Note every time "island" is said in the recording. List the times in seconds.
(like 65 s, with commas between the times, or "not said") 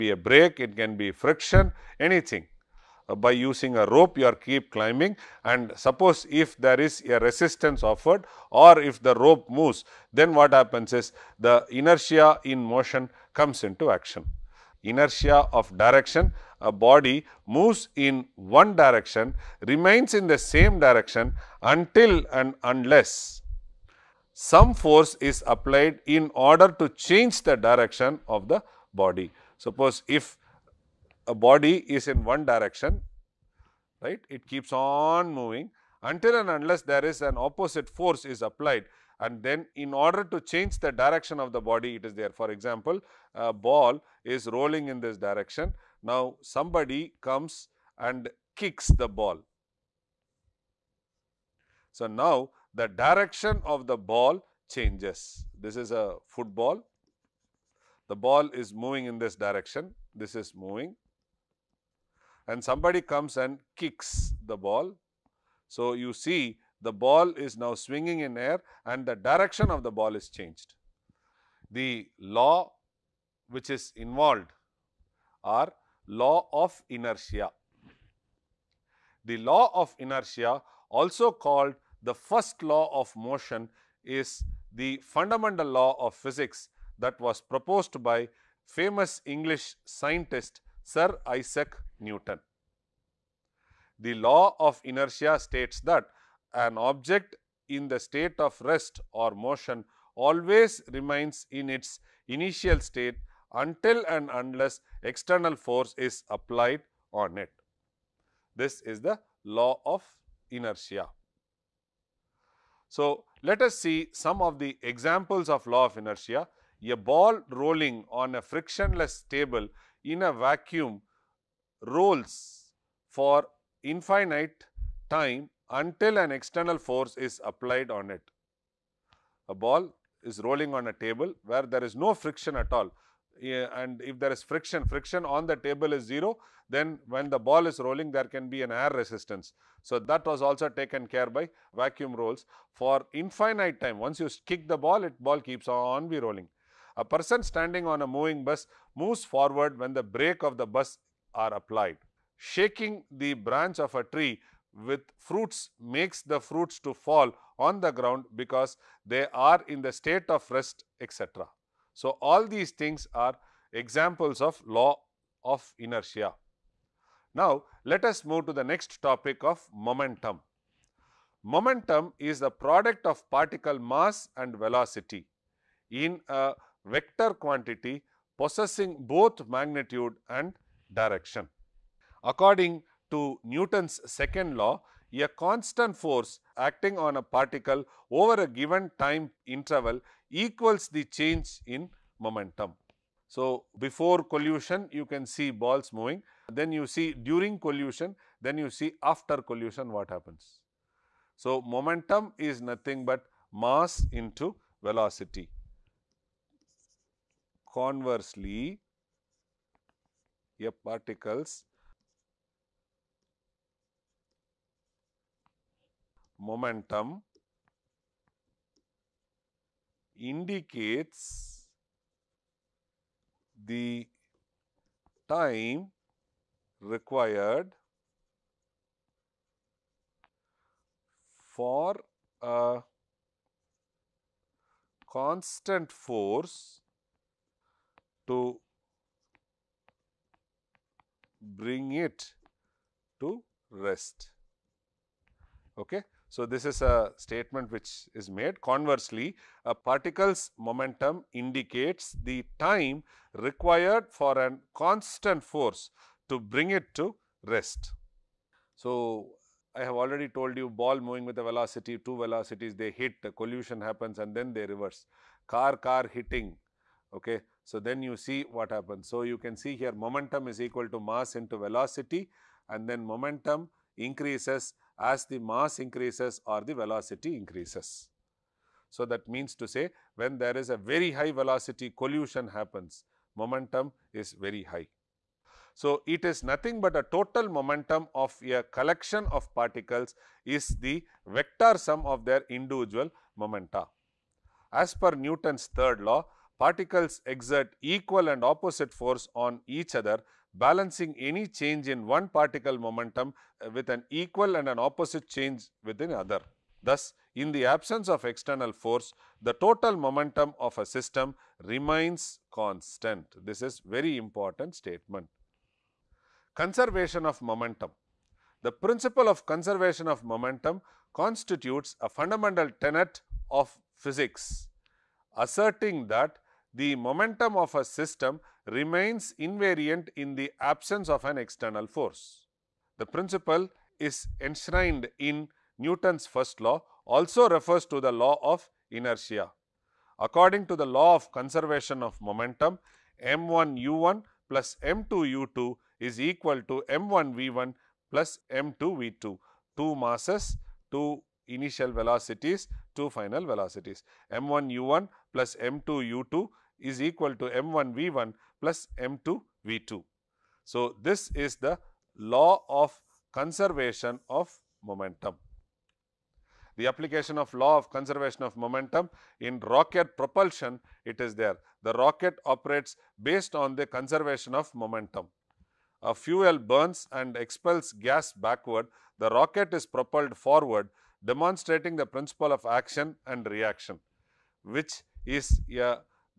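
not said.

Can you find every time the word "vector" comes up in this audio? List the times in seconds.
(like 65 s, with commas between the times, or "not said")
176 s, 291 s.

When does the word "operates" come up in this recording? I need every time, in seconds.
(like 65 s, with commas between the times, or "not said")
372 s.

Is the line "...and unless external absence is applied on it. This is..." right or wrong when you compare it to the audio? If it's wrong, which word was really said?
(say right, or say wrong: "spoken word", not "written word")
wrong: "force", not "absence".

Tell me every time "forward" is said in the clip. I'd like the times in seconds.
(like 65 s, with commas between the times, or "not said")
149 s, 380 s.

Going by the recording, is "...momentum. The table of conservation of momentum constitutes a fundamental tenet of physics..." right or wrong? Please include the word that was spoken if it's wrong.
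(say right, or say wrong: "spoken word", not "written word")
wrong: "principle", not "table".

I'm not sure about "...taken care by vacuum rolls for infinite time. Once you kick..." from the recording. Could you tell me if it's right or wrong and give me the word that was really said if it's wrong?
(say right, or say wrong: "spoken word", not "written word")
right.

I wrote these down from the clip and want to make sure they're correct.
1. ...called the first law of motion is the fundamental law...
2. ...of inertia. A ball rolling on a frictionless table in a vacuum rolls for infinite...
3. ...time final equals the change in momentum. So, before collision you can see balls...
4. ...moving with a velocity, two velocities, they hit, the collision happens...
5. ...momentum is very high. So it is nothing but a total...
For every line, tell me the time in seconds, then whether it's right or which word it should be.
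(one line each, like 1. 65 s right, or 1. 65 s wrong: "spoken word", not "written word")
1. 81 s right
2. 115 s right
3. 188 s wrong: "interval", not "final"
4. 260 s right
5. 283 s right.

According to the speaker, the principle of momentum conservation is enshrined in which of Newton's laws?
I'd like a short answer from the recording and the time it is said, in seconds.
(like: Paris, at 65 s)
Newton's first law, at 335 s.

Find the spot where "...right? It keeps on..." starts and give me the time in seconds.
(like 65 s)
34 s.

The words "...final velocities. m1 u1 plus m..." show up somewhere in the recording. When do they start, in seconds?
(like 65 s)
353 s.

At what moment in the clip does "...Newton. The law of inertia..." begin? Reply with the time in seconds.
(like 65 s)
91 s.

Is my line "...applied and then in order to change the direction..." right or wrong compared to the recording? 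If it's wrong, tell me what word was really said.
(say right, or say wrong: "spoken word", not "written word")
right.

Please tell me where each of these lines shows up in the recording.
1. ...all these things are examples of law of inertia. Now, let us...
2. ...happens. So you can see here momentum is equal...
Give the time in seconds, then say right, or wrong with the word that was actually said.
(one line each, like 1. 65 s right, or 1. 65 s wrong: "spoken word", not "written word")
1. 162 s right
2. 268 s right.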